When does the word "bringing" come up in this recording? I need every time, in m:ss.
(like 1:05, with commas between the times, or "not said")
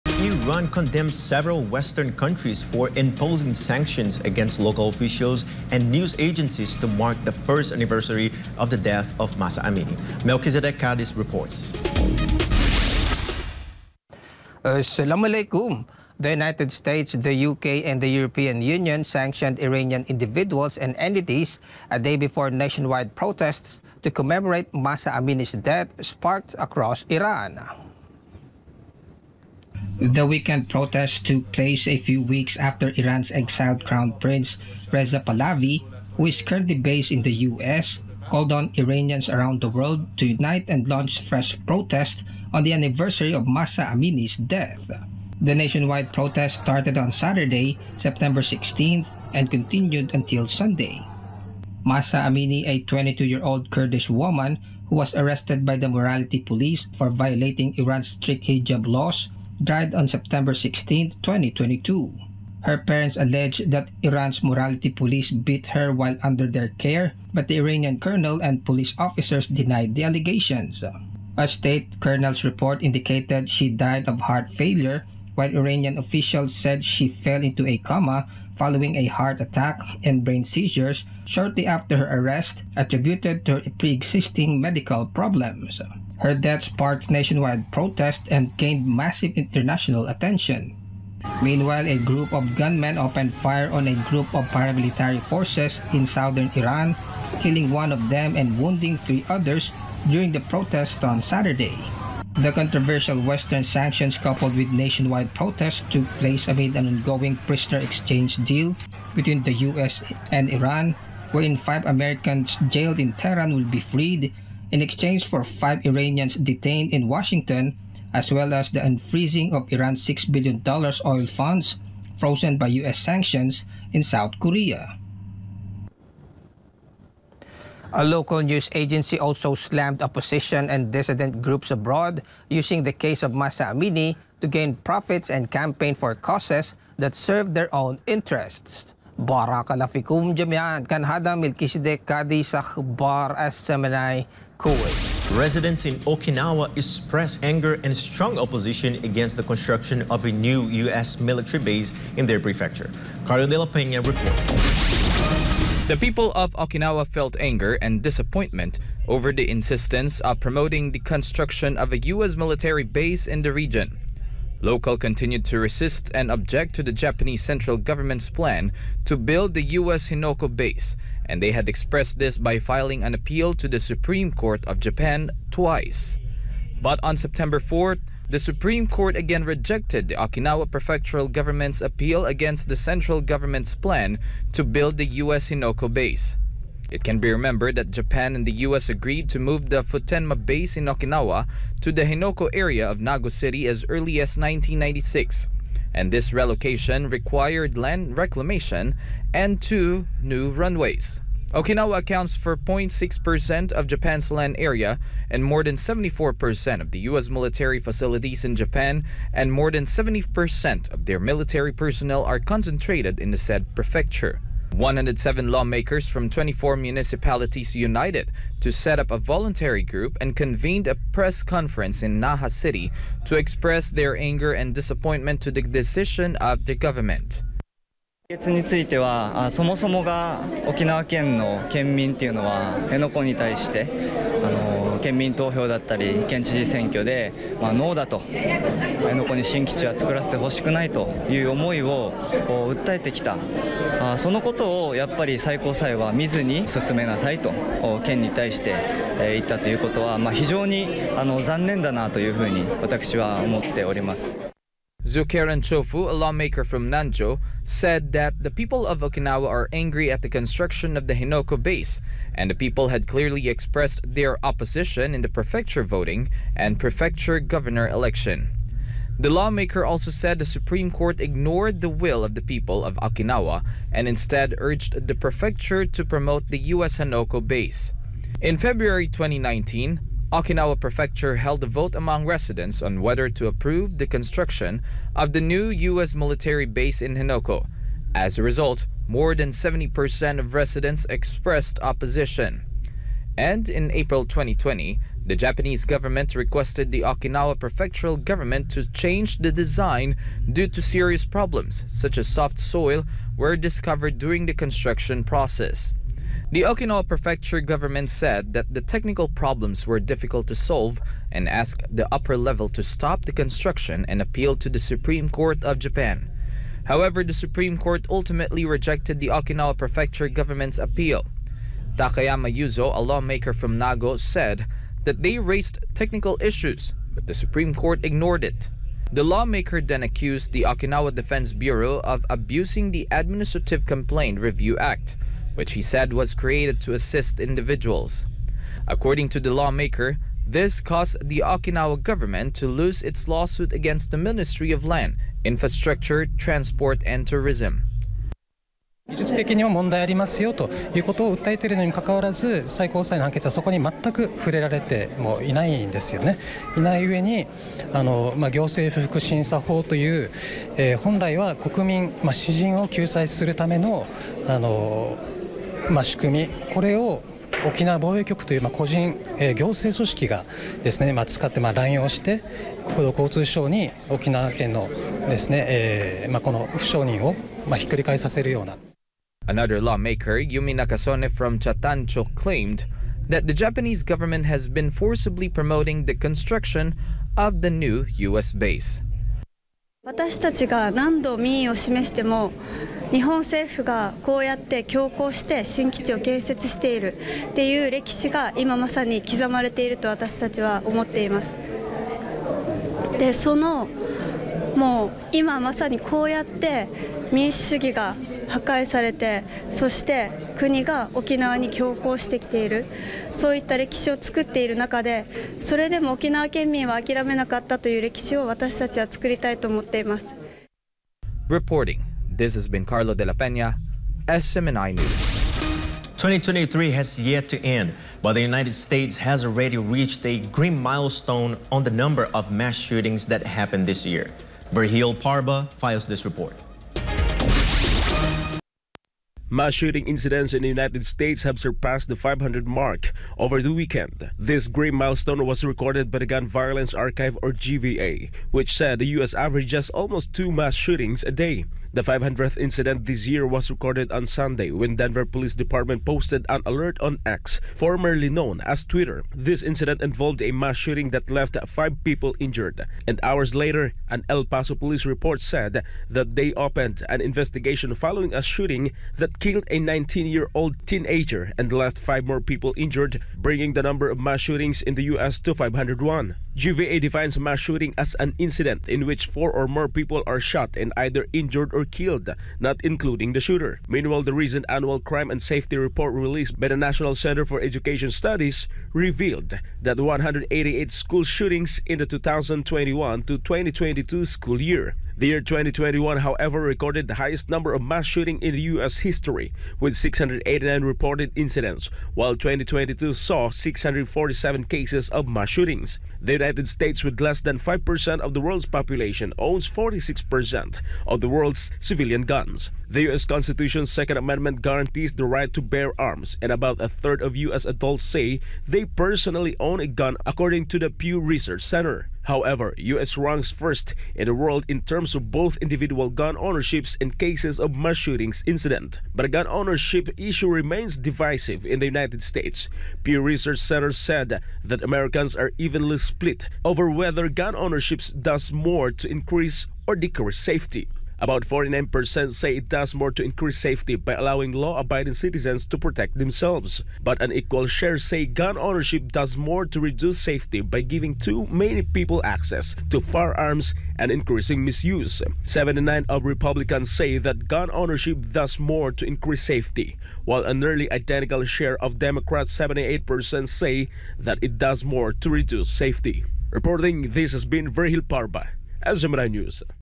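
7:53.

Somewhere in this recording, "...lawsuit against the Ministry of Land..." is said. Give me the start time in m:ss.
5:43.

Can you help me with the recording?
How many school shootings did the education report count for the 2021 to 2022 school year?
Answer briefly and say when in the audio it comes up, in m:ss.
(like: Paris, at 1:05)
188, at 8:09.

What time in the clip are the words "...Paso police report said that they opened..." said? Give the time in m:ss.
7:44.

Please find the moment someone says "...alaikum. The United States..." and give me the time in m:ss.
0:15.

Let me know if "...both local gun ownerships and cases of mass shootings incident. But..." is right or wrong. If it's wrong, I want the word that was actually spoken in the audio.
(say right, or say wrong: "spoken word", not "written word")
wrong: "individual", not "local".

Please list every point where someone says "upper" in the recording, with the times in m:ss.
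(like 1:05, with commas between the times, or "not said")
5:12.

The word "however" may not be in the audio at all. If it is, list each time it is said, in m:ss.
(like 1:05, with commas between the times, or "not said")
5:16, 8:16, 8:42.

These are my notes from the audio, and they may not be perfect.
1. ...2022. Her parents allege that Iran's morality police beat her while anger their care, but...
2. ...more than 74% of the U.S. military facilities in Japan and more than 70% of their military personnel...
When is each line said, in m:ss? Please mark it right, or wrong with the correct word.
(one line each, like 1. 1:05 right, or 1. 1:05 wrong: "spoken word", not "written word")
1. 1:01 wrong: "under", not "anger"
2. 3:25 right.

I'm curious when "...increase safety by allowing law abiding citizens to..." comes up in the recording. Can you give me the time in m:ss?
9:03.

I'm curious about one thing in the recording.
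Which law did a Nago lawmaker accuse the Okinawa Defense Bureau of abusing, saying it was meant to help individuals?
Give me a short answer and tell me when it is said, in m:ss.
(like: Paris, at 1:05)
Administrative Complaint Review Act, at 5:33.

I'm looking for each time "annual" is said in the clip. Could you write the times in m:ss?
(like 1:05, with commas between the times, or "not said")
8:04.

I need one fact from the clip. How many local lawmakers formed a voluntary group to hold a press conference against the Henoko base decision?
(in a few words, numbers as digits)
107.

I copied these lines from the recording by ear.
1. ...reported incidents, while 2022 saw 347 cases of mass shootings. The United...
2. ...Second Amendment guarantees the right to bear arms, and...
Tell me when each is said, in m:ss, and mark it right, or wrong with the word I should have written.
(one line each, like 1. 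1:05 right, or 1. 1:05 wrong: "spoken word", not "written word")
1. 8:20 wrong: "647", not "347"
2. 8:33 right.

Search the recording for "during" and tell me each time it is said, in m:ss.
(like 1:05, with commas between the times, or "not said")
1:40, 5:04.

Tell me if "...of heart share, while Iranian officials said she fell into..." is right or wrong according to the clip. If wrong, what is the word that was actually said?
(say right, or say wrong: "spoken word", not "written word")
wrong: "failure", not "share".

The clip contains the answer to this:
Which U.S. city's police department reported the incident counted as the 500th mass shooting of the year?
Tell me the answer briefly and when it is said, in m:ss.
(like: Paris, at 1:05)
Denver, at 7:34.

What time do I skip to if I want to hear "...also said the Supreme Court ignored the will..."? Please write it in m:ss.
4:29.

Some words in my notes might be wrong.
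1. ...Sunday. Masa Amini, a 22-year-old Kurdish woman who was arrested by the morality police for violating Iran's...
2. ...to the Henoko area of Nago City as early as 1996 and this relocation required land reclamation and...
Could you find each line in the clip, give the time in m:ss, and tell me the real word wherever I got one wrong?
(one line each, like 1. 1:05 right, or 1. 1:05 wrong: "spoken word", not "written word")
1. 0:50 right
2. 3:11 right.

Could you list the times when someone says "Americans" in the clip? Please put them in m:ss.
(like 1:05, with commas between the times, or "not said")
1:51, 8:54.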